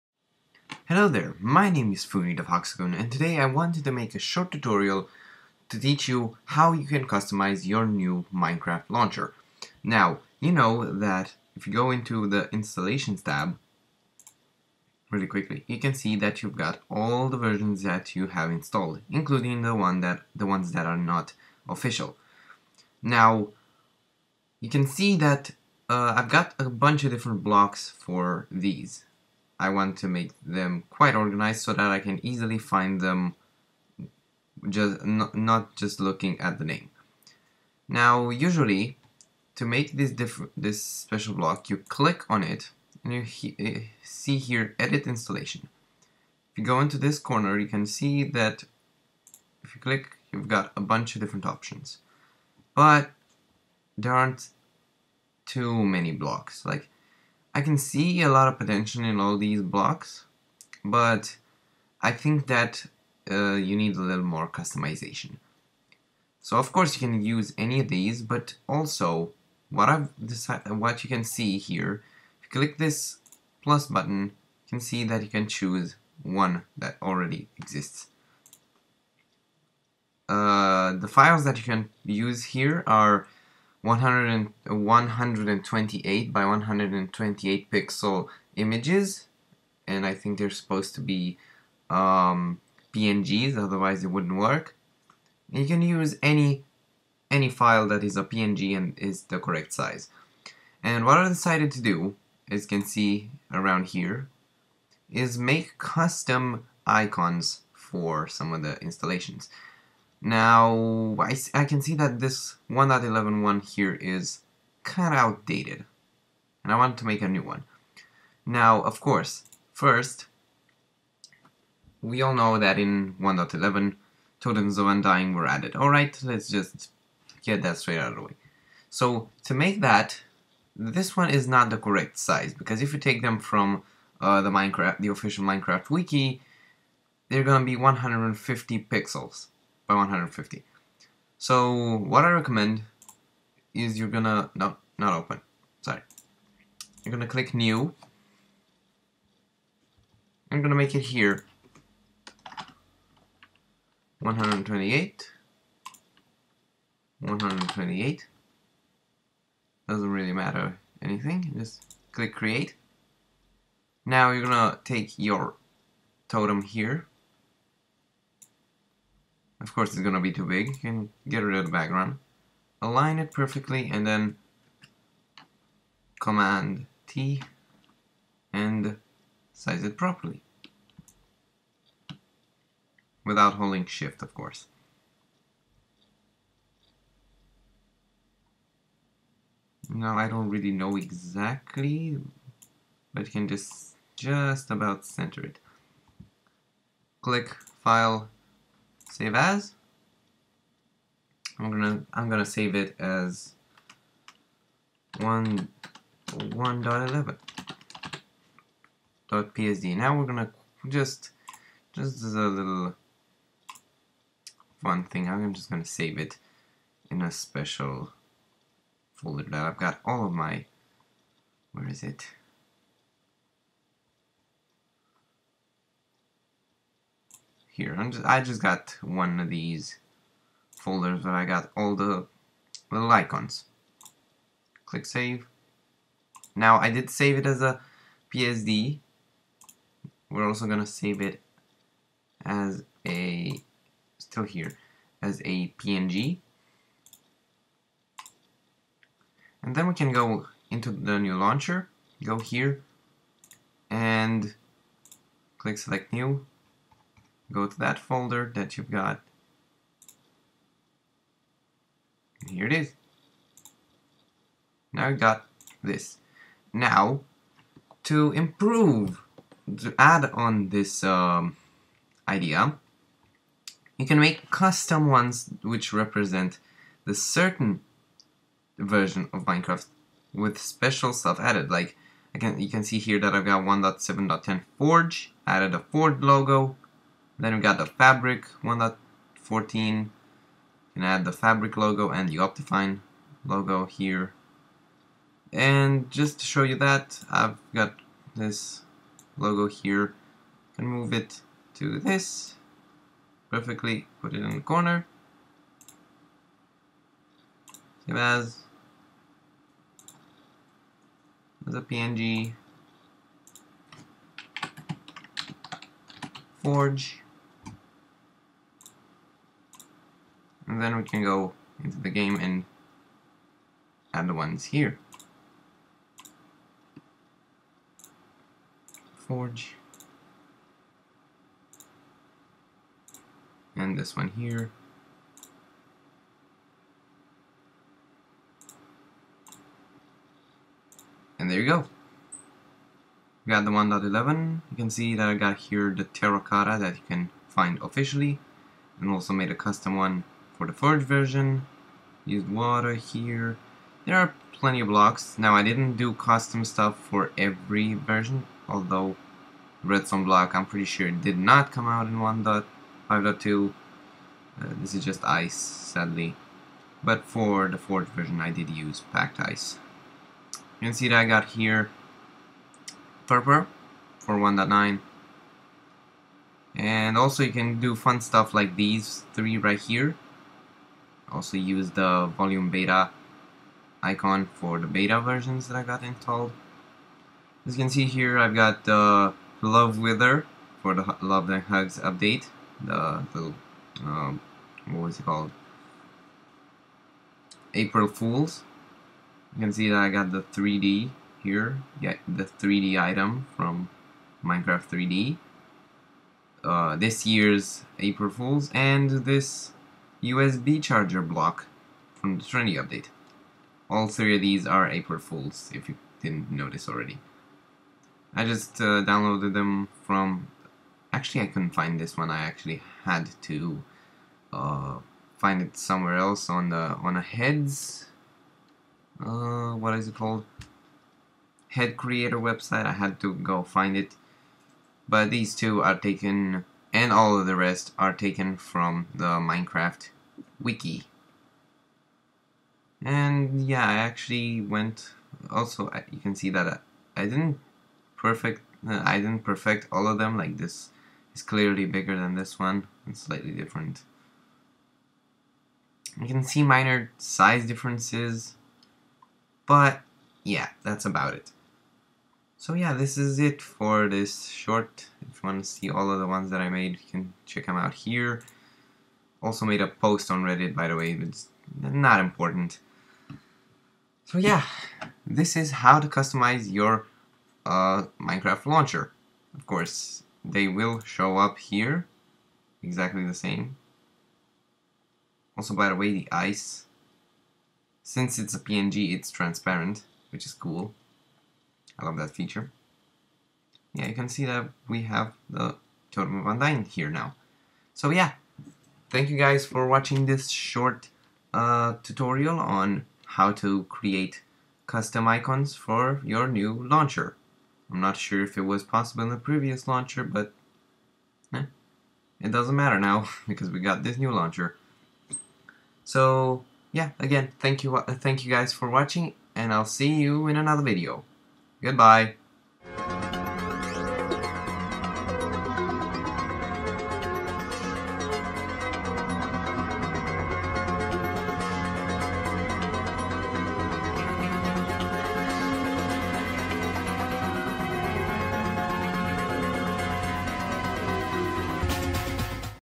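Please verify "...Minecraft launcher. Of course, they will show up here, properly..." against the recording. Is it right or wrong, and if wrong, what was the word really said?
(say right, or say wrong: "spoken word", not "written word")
wrong: "exactly", not "properly".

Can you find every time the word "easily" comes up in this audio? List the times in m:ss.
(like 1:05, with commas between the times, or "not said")
0:32.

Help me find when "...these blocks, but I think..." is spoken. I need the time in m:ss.
0:59.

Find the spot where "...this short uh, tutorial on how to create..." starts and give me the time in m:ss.
8:20.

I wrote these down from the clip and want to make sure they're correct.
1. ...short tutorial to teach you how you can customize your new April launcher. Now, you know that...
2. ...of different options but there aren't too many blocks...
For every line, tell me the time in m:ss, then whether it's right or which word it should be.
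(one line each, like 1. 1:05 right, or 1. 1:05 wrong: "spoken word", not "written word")
1. 0:04 wrong: "Minecraft", not "April"
2. 0:51 right.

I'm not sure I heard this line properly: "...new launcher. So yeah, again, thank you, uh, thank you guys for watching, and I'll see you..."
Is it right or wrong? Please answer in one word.
right.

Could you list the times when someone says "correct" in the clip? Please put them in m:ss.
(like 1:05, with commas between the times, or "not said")
1:39, 2:11.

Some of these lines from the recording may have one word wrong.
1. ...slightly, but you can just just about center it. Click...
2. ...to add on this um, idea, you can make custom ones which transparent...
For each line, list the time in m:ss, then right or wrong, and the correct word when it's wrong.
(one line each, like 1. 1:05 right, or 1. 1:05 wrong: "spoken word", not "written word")
1. 3:10 wrong: "exactly", not "slightly"
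2. 4:29 wrong: "represent", not "transparent".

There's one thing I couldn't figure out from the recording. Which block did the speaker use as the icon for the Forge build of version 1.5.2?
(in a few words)
Packed ice.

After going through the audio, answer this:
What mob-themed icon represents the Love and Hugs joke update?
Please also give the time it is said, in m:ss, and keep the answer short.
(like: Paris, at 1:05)
Love Wither, at 6:29.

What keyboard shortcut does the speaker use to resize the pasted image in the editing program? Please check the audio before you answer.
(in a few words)
Command T.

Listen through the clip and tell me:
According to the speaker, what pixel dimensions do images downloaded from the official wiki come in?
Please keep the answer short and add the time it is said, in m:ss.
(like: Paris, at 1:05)
150 by 150, at 2:17.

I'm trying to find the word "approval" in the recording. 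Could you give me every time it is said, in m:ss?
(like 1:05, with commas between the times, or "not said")
not said.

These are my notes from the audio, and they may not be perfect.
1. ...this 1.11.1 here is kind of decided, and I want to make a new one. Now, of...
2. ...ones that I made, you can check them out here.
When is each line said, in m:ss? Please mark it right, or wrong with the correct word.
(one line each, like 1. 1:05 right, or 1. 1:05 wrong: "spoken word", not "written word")
1. 1:52 wrong: "outdated", not "decided"
2. 7:46 right.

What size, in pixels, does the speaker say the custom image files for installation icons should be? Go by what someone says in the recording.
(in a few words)
128 by 128.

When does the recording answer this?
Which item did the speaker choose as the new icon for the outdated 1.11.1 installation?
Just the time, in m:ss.
2:04.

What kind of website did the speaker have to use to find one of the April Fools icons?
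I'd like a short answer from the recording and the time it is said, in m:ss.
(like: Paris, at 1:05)
Head creator website, at 7:11.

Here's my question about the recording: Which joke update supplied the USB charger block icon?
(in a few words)
Trendy update.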